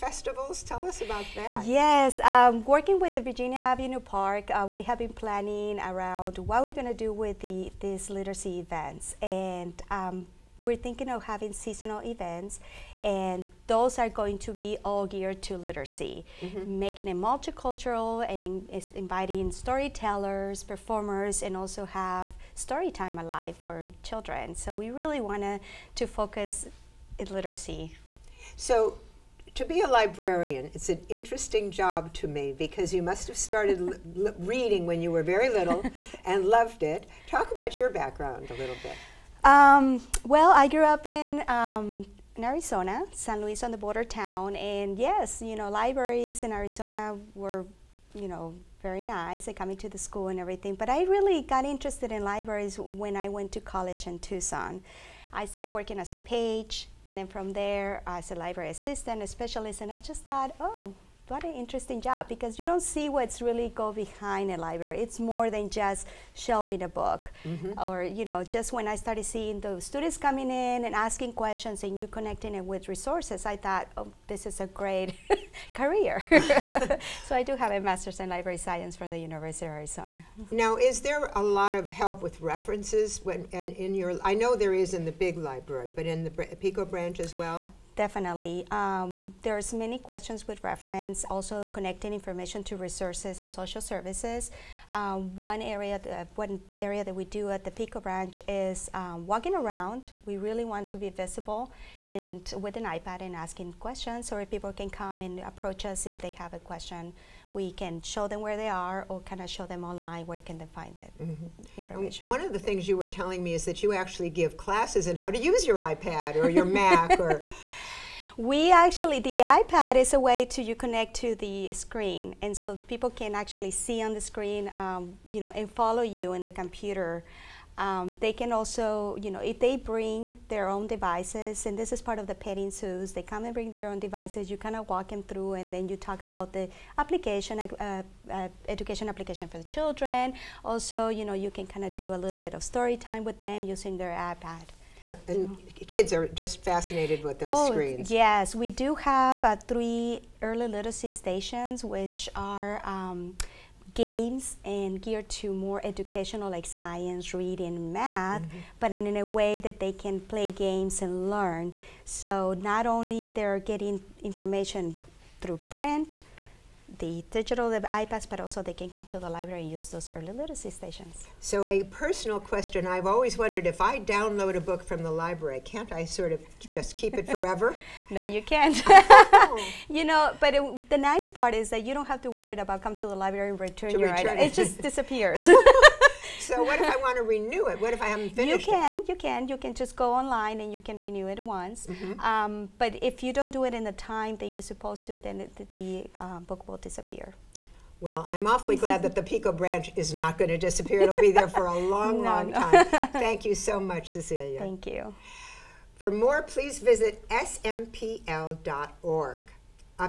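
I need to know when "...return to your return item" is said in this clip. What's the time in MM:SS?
03:03.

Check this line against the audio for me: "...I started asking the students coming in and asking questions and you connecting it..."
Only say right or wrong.
wrong.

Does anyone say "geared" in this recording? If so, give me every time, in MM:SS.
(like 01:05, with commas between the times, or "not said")
00:15, 02:35.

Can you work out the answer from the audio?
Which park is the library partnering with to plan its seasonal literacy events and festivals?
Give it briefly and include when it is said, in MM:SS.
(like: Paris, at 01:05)
Virginia Avenue Park, at 00:03.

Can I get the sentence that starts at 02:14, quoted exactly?
You kind of walk them through, and then you talk about the application, uh, uh, education application for the children.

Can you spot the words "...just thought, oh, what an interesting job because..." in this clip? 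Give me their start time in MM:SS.
00:59.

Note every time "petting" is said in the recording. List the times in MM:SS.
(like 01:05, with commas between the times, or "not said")
02:12.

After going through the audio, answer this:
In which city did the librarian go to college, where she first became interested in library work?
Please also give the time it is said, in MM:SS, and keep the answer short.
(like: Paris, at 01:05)
Tucson, at 00:54.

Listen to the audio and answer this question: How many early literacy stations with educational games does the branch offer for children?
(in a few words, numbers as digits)
3.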